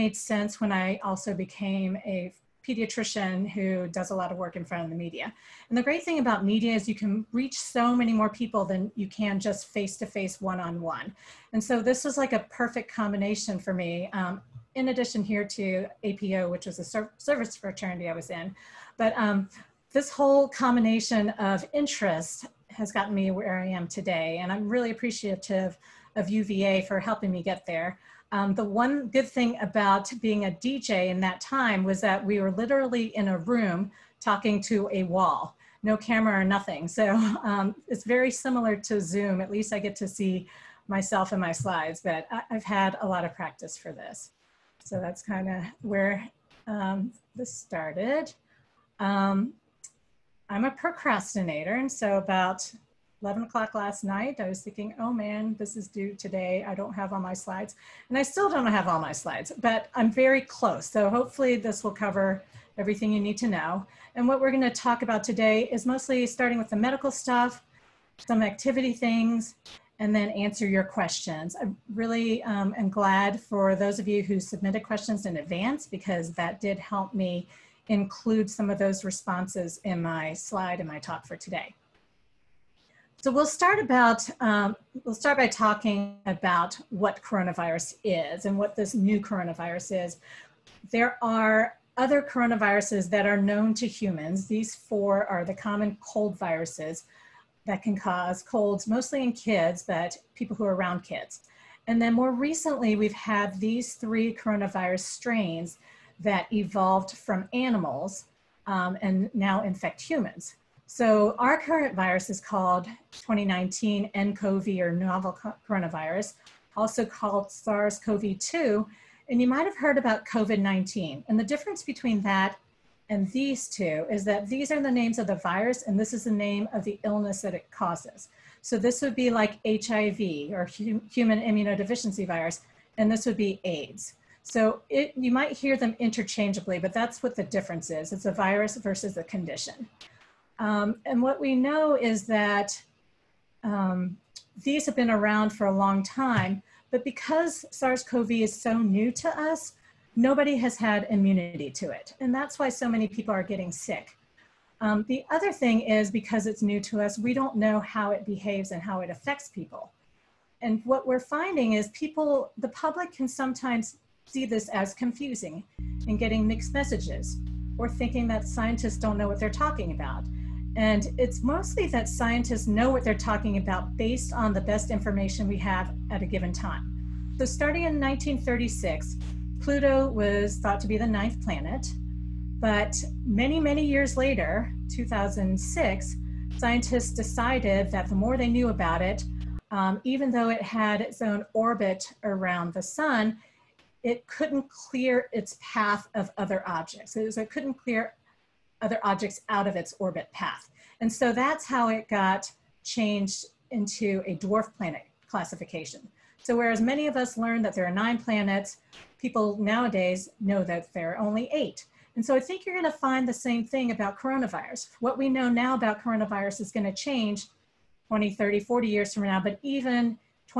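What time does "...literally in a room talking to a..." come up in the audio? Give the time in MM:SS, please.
00:32.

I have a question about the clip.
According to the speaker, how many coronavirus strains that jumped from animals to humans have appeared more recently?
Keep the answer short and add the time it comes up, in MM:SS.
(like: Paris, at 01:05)
3, at 01:43.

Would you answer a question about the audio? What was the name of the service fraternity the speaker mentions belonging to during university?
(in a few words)
APO.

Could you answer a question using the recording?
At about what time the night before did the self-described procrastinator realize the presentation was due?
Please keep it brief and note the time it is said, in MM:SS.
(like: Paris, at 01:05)
11 o'clock, at 00:53.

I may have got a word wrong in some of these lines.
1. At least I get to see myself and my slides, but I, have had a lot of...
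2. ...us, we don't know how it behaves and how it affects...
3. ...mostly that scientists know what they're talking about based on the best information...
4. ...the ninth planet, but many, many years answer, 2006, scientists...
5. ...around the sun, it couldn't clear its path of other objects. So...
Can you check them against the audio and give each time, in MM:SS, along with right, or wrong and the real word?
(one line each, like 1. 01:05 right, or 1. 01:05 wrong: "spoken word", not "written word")
1. 00:39 right
2. 02:37 right
3. 02:51 right
4. 03:00 wrong: "later", not "answer"
5. 03:12 right.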